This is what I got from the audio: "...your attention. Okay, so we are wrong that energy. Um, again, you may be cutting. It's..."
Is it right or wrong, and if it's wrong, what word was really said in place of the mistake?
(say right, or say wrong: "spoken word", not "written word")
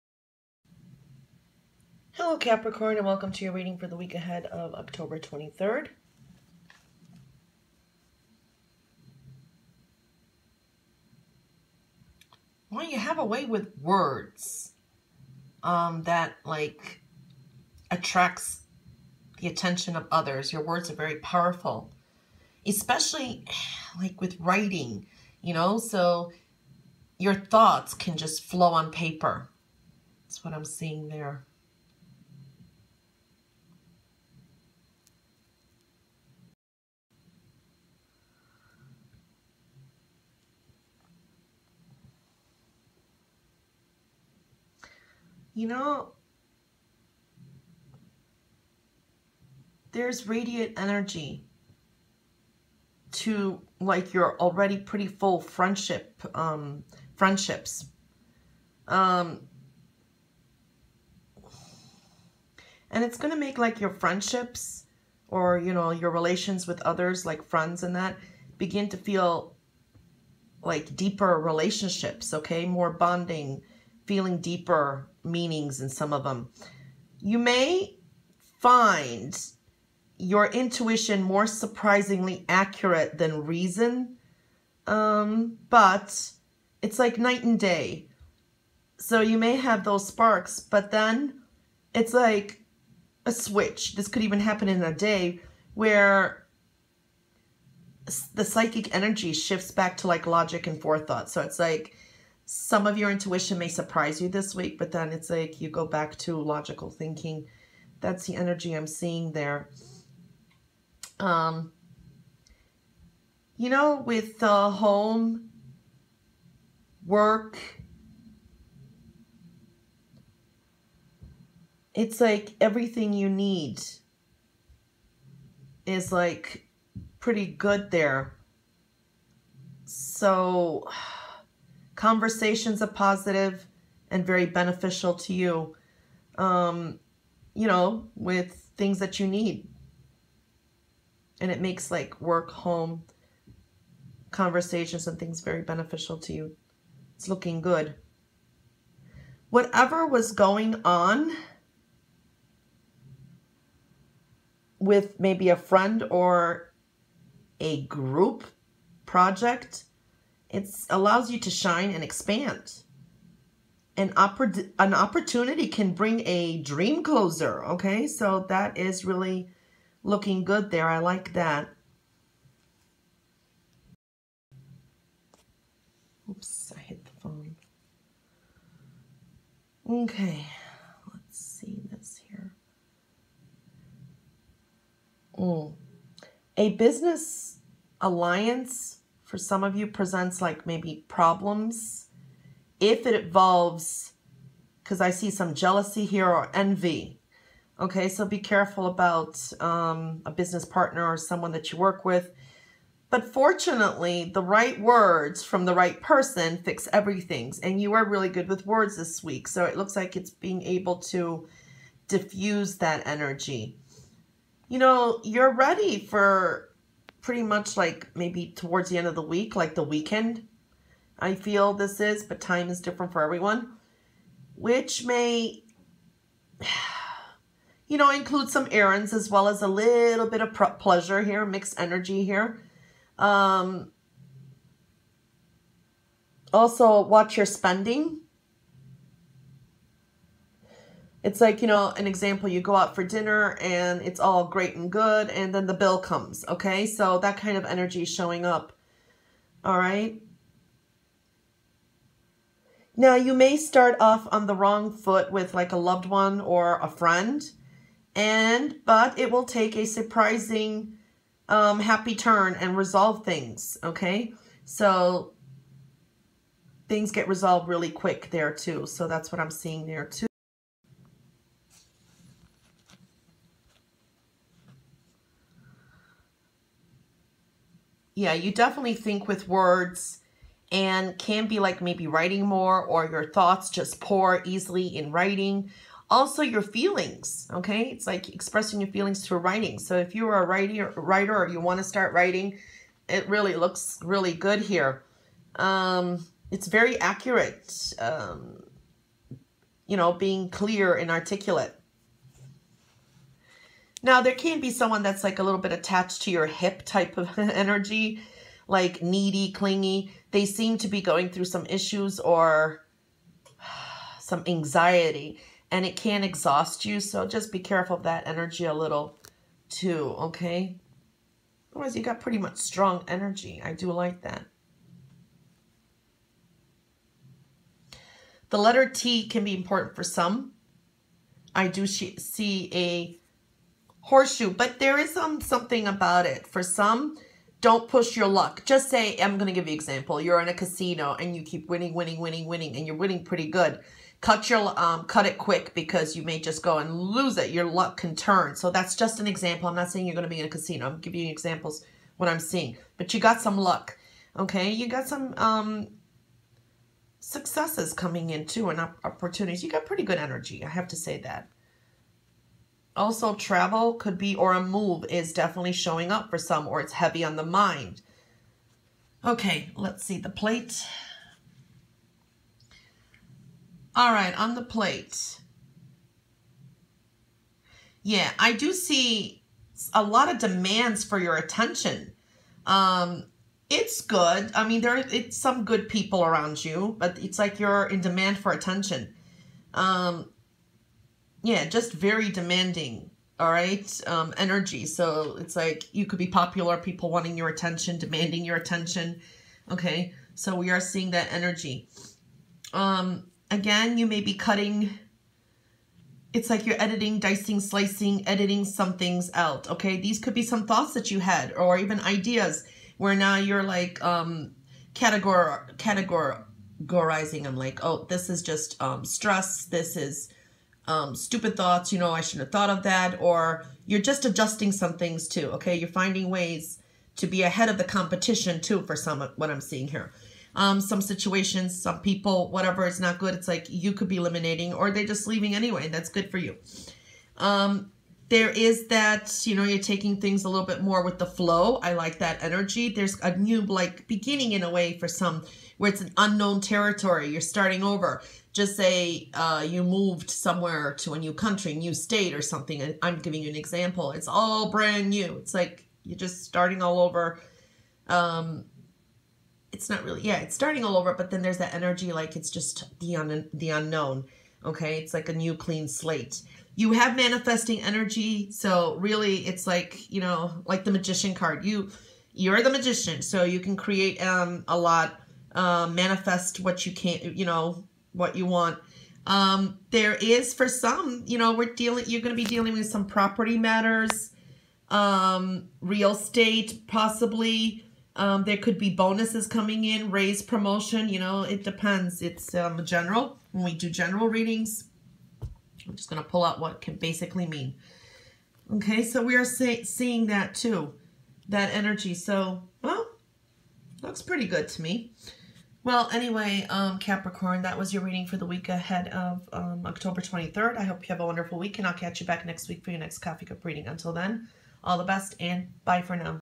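wrong: "seeing", not "wrong".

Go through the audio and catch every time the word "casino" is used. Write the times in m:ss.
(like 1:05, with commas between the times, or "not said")
5:40, 5:50.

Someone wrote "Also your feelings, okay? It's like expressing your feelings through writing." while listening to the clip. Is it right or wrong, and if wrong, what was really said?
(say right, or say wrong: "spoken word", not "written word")
right.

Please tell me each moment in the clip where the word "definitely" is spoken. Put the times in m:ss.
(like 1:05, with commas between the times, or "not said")
4:38, 6:05.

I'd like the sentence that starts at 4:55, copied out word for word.
Um, it's very accurate, um, you know, being clear and articulate.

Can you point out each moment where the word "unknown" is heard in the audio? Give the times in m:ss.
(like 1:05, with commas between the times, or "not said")
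7:26, 7:43.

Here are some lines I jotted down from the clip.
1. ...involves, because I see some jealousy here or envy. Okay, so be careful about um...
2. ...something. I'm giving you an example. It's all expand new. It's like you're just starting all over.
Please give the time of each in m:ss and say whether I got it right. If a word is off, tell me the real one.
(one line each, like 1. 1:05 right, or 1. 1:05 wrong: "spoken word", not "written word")
1. 3:13 right
2. 7:32 wrong: "brand", not "expand".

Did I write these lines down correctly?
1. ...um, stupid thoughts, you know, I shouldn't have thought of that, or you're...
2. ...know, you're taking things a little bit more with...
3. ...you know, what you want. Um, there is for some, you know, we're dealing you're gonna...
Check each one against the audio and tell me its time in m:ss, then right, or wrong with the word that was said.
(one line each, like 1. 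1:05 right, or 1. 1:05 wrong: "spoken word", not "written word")
1. 7:00 right
2. 7:19 right
3. 7:57 right.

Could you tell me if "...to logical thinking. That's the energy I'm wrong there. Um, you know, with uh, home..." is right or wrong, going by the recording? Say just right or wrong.
wrong.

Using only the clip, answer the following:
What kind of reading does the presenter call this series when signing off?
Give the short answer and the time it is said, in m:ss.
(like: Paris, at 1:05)
Coffee Cup reading, at 8:33.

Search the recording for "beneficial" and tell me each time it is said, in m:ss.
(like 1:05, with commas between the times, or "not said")
2:14, 2:25.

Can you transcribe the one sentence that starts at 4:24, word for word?
So things get resolved really quick there too.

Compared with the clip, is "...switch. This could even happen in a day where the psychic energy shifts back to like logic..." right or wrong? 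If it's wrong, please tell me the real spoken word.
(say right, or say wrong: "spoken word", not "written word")
right.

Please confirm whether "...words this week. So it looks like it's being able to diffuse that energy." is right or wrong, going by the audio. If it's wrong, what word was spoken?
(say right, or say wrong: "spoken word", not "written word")
right.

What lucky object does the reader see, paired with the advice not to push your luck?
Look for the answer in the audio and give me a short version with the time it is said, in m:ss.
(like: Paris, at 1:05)
A horseshoe, at 5:34.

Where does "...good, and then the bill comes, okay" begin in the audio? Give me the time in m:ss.
4:04.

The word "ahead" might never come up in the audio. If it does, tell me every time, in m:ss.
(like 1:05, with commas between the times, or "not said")
0:04, 7:07, 8:28.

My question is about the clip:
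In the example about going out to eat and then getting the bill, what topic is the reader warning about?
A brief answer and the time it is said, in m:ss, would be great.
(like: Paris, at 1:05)
Spending, at 3:57.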